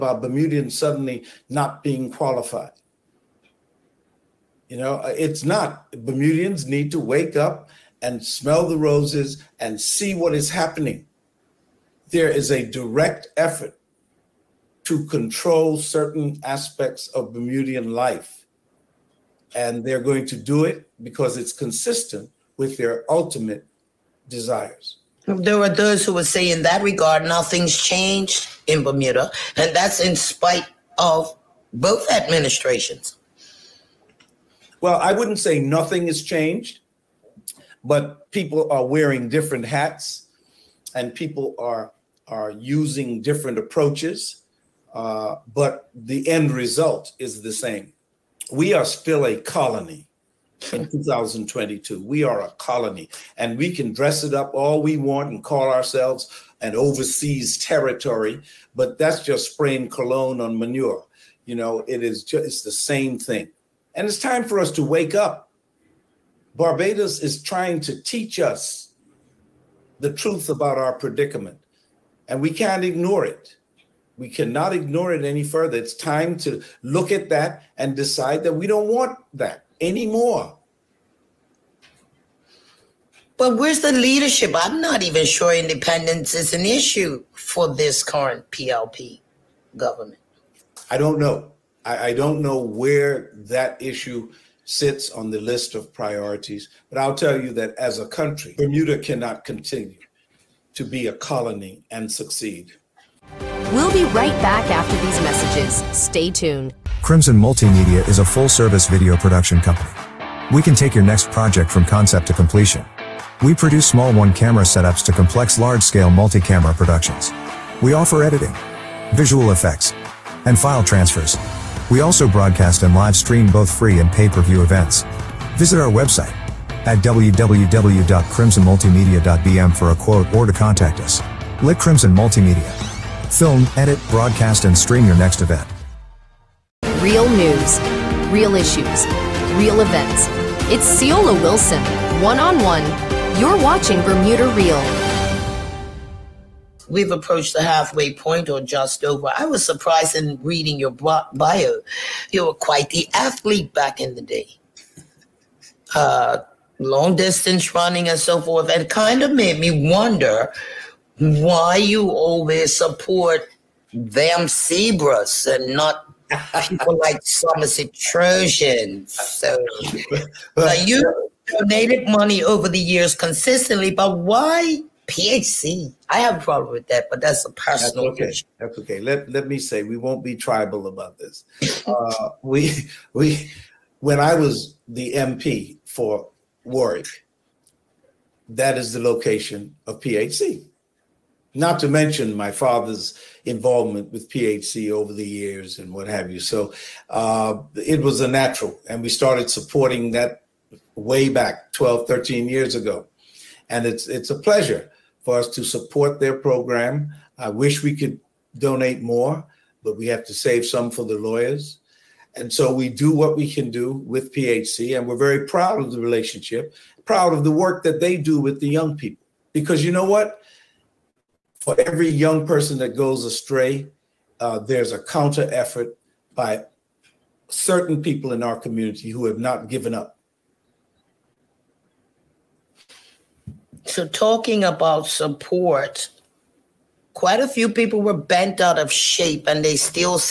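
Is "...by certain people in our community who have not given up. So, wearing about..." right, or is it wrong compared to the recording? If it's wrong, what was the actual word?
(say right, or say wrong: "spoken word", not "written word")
wrong: "talking", not "wearing".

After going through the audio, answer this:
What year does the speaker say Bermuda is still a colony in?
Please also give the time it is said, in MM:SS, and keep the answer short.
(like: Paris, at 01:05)
2022, at 00:50.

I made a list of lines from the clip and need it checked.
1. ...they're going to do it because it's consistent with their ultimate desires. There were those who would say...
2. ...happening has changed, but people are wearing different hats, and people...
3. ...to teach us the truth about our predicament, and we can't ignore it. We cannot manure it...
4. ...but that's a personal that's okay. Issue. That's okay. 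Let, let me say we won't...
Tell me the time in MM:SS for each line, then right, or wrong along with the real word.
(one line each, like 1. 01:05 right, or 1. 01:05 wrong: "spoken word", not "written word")
1. 00:19 right
2. 00:35 wrong: "nothing", not "happening"
3. 01:07 wrong: "ignore", not "manure"
4. 02:57 right.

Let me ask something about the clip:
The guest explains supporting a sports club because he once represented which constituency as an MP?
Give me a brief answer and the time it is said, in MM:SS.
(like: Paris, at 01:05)
Warwick, at 03:06.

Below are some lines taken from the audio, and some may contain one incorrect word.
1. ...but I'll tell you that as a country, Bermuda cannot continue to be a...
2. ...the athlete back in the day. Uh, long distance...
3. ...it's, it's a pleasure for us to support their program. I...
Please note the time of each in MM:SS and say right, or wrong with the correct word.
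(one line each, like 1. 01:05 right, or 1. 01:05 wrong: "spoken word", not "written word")
1. 01:36 right
2. 02:32 right
3. 03:23 right.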